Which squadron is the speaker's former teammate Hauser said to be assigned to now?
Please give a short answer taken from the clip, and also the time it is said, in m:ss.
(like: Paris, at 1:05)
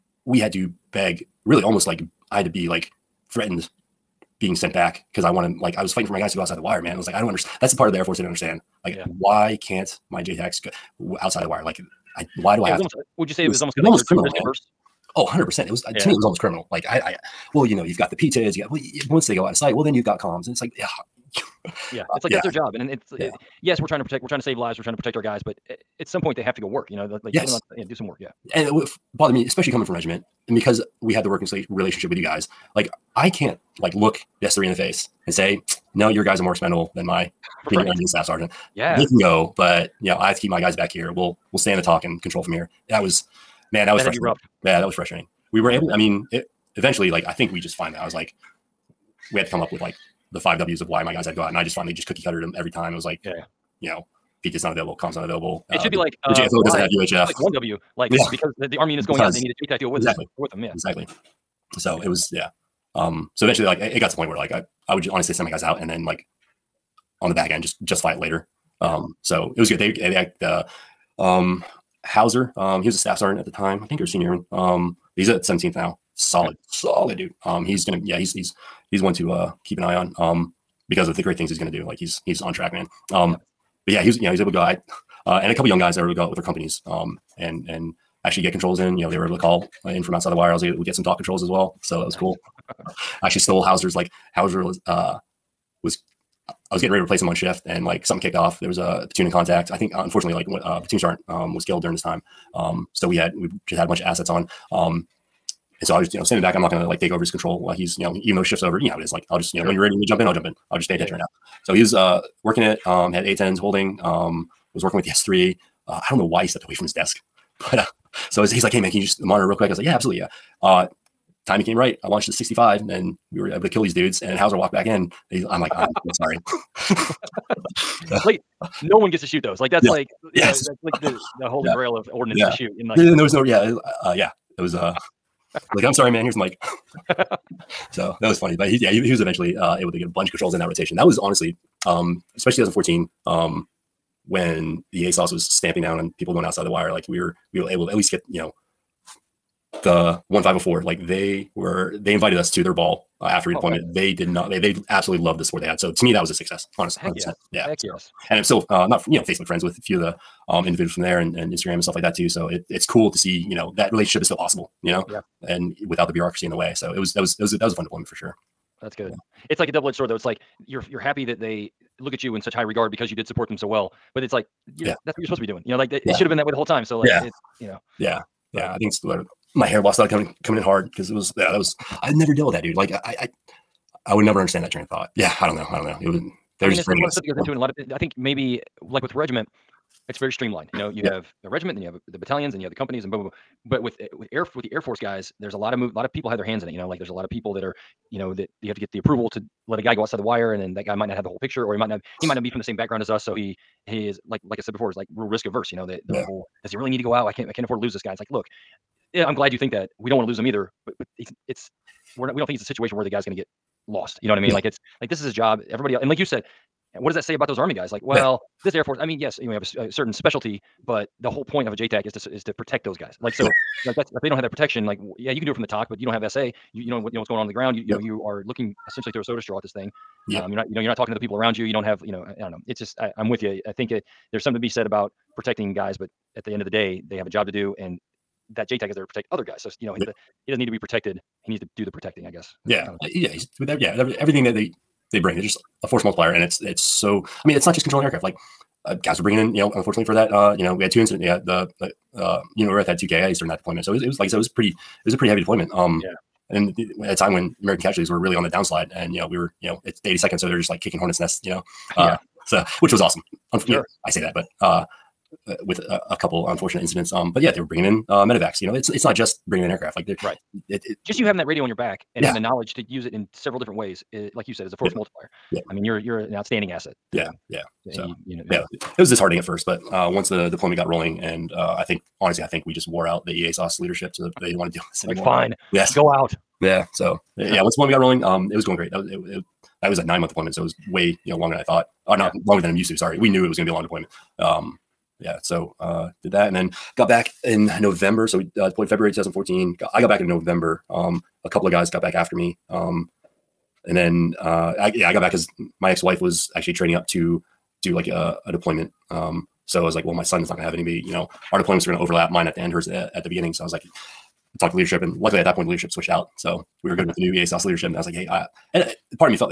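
17th, at 1:15.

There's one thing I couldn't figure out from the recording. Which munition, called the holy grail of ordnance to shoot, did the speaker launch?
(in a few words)
65.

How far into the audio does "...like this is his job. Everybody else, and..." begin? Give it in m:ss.
3:35.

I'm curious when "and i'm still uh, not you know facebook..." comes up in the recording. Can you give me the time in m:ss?
2:38.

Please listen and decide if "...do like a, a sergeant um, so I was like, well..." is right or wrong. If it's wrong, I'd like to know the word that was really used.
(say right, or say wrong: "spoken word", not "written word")
wrong: "deployment", not "sergeant".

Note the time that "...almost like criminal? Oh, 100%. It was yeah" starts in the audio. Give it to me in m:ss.
0:13.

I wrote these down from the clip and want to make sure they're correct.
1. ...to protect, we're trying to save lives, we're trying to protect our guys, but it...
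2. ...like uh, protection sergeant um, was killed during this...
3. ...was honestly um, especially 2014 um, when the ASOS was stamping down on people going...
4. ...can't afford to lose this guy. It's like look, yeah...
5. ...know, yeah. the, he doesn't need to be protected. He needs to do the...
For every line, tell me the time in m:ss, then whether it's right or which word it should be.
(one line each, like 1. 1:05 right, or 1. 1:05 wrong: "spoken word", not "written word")
1. 0:23 right
2. 1:40 wrong: "platoon", not "protection"
3. 2:21 right
4. 3:27 right
5. 3:59 right.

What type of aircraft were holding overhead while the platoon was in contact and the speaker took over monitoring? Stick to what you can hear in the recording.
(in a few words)
A-10s.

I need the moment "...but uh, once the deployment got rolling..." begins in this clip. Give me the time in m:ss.
4:39.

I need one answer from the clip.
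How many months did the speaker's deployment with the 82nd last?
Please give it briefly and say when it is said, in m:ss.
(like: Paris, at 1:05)
9, at 4:50.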